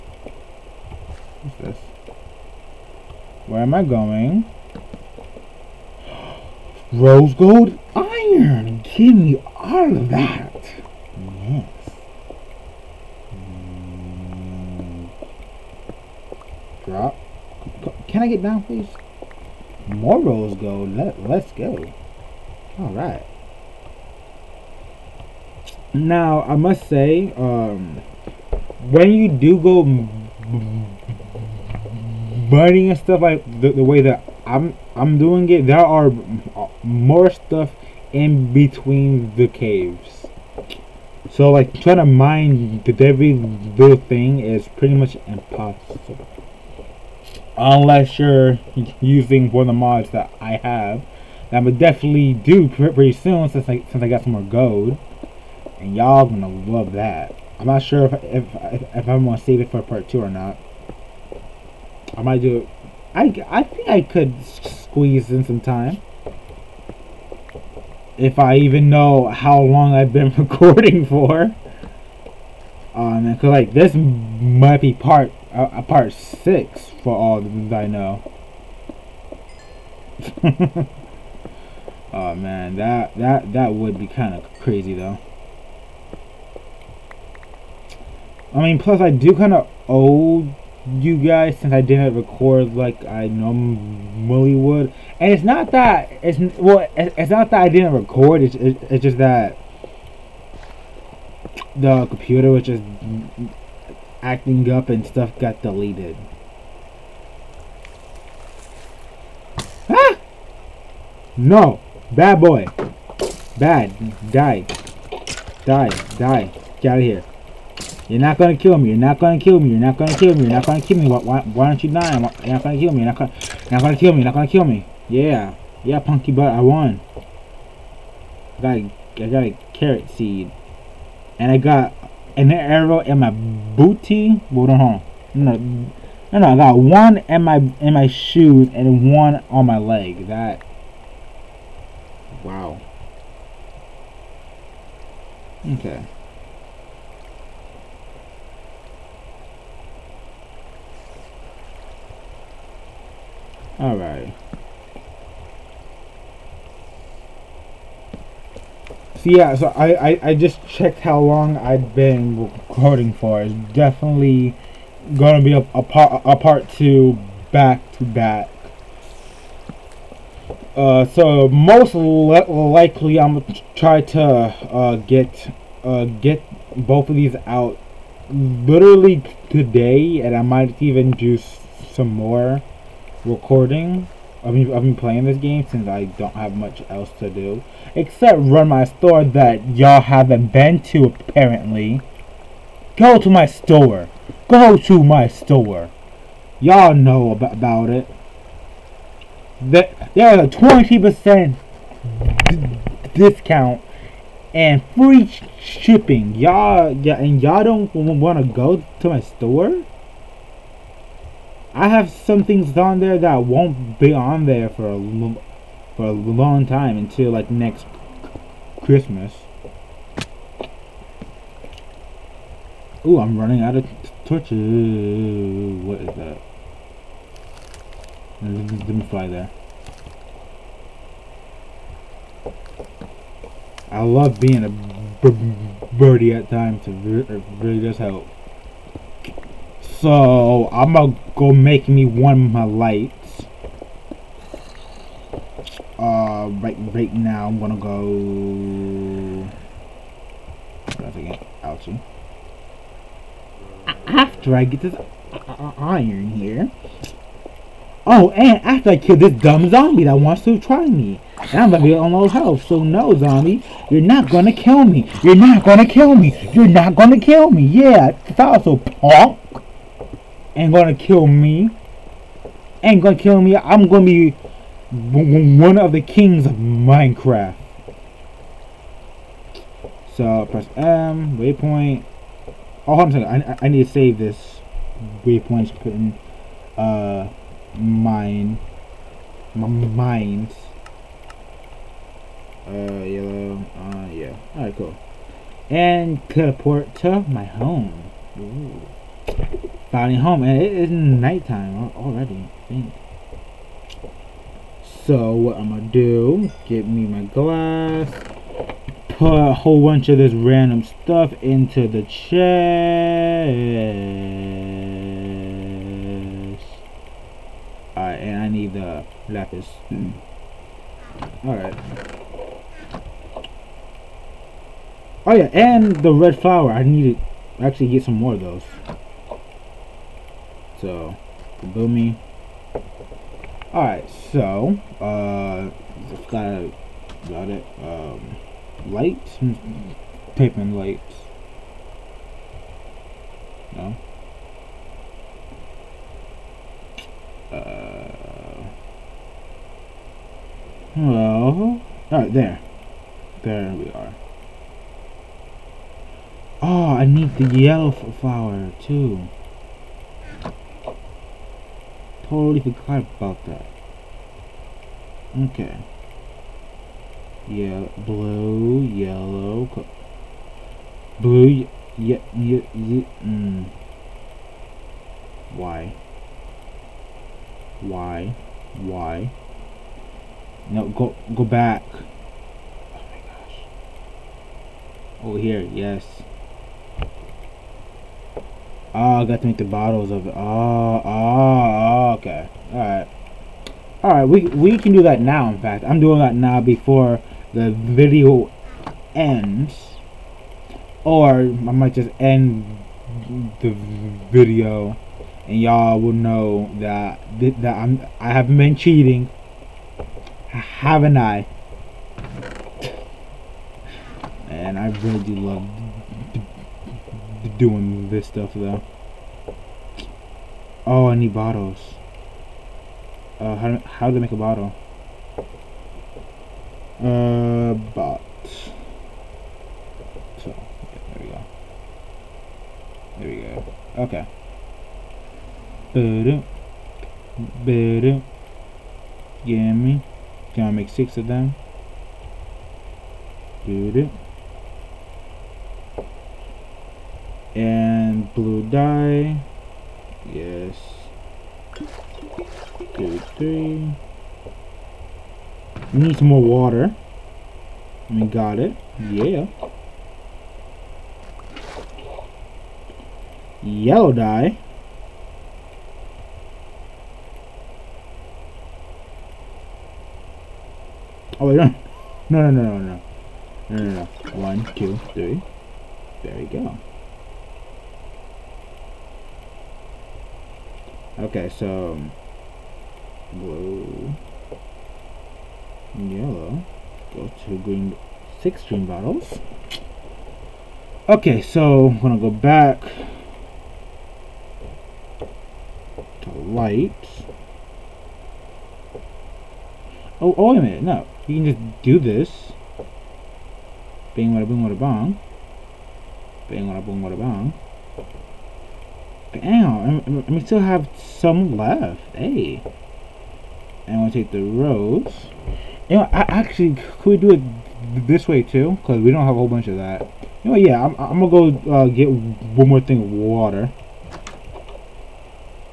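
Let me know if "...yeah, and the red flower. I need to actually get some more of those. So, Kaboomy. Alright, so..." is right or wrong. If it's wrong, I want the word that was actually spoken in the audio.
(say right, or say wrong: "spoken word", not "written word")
right.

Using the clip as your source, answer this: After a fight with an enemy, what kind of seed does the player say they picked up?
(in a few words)
carrot seed.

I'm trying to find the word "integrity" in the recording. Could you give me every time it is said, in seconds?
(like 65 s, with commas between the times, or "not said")
not said.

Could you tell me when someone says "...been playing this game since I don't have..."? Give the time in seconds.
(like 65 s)
184 s.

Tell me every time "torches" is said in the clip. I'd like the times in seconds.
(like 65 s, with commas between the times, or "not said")
224 s.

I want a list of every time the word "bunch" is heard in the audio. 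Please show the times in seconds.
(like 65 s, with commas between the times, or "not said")
309 s, 519 s.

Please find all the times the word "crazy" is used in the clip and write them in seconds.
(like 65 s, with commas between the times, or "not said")
84 s.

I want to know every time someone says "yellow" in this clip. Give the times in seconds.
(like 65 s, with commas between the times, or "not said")
293 s, 357 s, 368 s, 463 s, 485 s.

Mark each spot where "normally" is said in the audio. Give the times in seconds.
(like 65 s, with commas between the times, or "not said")
93 s.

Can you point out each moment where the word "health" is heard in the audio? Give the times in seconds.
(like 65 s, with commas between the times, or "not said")
262 s.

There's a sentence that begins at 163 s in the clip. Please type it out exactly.
It's definitely gonna be a, a part a part two back to back.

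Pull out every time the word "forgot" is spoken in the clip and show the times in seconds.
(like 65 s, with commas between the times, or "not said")
362 s.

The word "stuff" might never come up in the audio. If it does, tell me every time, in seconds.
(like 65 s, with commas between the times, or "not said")
32 s, 37 s, 105 s, 310 s, 418 s.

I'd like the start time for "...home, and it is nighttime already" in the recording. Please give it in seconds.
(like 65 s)
300 s.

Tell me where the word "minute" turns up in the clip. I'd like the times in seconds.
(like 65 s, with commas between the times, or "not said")
500 s.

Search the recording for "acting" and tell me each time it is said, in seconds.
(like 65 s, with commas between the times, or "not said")
104 s.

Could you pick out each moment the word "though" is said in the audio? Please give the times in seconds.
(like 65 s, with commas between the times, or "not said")
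84 s, 418 s.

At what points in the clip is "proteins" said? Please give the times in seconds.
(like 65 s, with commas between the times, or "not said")
not said.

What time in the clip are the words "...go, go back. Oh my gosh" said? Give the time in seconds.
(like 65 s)
380 s.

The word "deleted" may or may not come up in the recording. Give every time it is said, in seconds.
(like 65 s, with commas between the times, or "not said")
105 s.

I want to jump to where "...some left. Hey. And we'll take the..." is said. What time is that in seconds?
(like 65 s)
510 s.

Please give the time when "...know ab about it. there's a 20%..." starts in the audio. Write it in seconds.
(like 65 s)
196 s.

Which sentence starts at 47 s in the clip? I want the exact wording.
Unless you're using one of the mods that I have.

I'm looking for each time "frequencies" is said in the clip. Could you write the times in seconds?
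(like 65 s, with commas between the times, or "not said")
not said.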